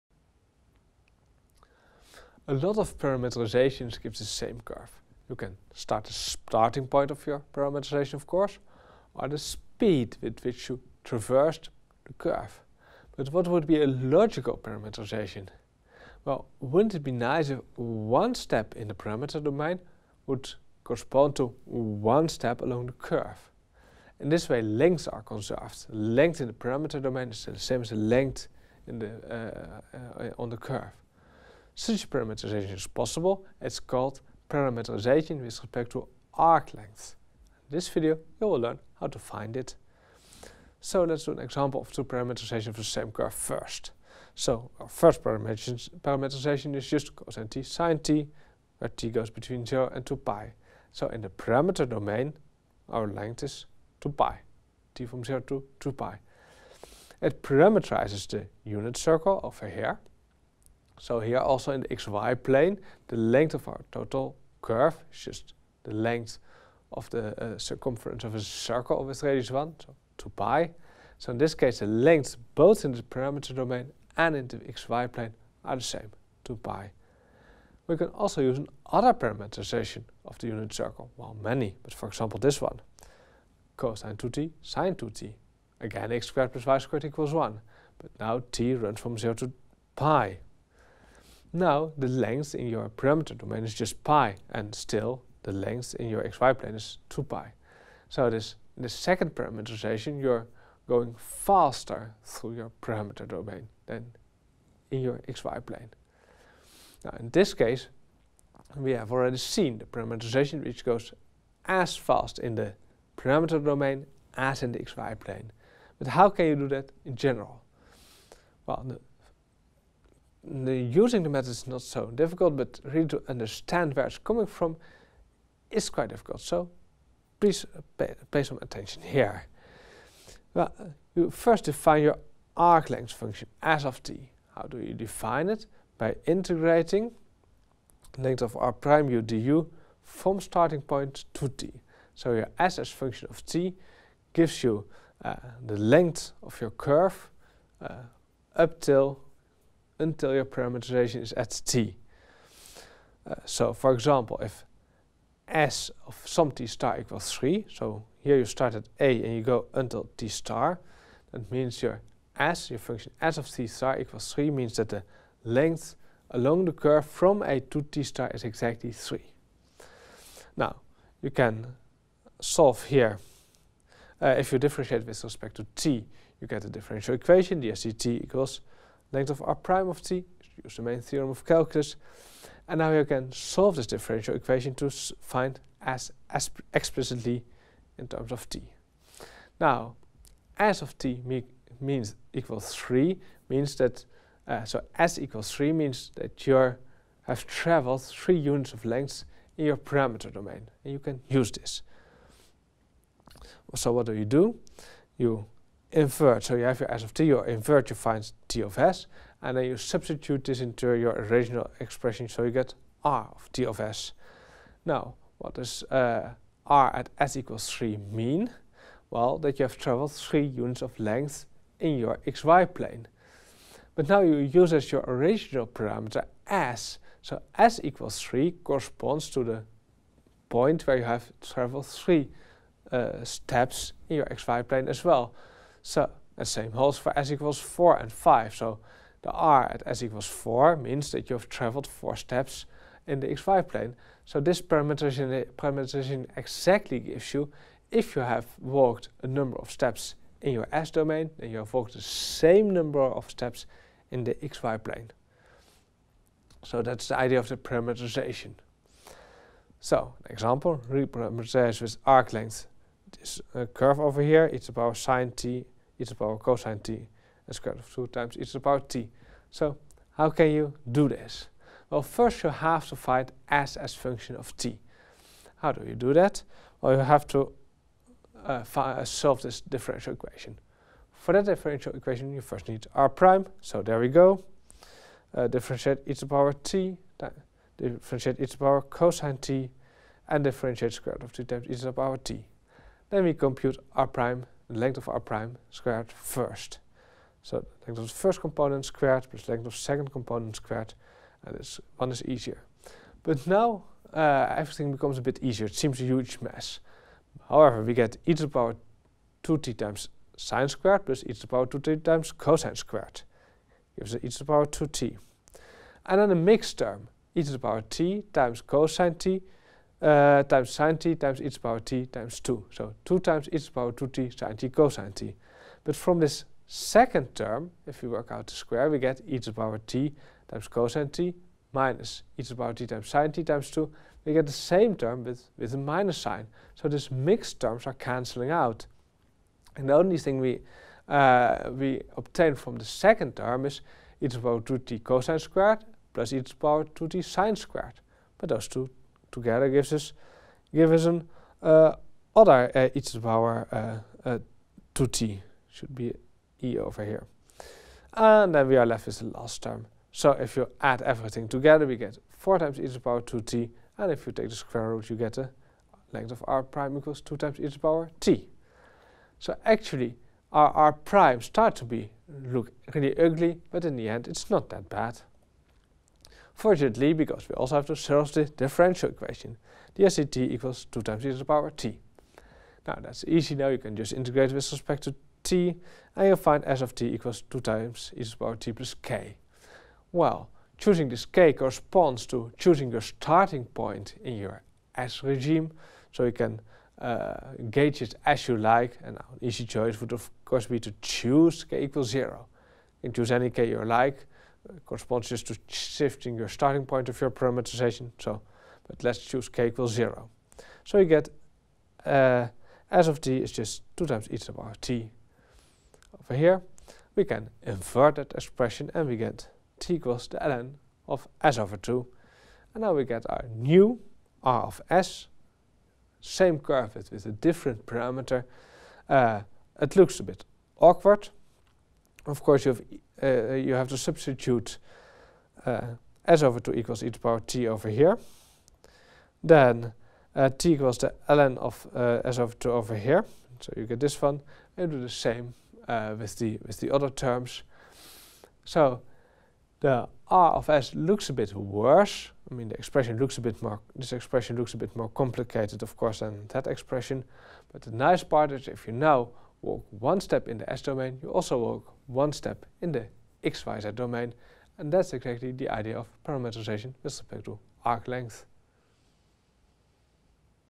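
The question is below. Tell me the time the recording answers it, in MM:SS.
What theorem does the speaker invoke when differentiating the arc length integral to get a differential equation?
03:00.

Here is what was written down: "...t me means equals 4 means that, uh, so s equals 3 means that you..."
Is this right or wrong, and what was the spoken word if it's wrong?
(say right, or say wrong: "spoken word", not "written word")
wrong: "3", not "4".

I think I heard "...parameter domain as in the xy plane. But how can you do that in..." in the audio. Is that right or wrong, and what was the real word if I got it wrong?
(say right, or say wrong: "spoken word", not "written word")
right.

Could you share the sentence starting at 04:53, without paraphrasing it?
Then we compute r prime, the length of r prime squared first.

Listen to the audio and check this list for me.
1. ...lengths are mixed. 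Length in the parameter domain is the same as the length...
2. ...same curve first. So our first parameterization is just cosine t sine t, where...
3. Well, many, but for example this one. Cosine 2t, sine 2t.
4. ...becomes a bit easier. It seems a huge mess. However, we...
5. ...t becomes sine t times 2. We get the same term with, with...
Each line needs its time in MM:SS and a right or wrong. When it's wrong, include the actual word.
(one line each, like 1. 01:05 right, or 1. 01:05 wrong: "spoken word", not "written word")
1. 00:24 wrong: "conserved", not "mixed"
2. 00:42 right
3. 01:21 right
4. 05:04 right
5. 05:32 wrong: "times", not "becomes".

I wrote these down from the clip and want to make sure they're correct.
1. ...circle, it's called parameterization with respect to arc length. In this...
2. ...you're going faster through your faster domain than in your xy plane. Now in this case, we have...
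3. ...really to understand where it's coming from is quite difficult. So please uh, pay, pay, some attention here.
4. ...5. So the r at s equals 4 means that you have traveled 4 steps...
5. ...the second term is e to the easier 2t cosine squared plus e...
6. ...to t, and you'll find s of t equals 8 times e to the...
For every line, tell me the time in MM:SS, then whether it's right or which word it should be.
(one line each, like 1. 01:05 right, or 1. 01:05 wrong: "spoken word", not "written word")
1. 00:32 wrong: "possible", not "circle"
2. 01:40 wrong: "parameter", not "faster"
3. 02:02 right
4. 03:58 right
5. 05:42 wrong: "power", not "easier"
6. 06:25 wrong: "2", not "8".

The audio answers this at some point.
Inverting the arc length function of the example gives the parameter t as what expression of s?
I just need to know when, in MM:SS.
07:00.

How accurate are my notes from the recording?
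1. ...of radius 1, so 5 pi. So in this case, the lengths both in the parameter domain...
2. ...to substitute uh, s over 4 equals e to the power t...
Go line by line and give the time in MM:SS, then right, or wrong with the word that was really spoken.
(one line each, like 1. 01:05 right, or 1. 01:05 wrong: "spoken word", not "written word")
1. 01:09 wrong: "2", not "5"
2. 07:13 wrong: "2", not "4".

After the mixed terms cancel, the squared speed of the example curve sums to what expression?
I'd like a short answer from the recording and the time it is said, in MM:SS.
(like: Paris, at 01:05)
4e^(2t), at 06:02.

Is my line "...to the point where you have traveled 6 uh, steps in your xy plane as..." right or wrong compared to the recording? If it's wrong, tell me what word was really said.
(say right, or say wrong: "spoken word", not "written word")
wrong: "3", not "6".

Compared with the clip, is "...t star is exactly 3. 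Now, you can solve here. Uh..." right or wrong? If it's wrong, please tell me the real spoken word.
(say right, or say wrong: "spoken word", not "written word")
right.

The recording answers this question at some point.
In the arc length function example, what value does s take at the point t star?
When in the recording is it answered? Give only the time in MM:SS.
02:34.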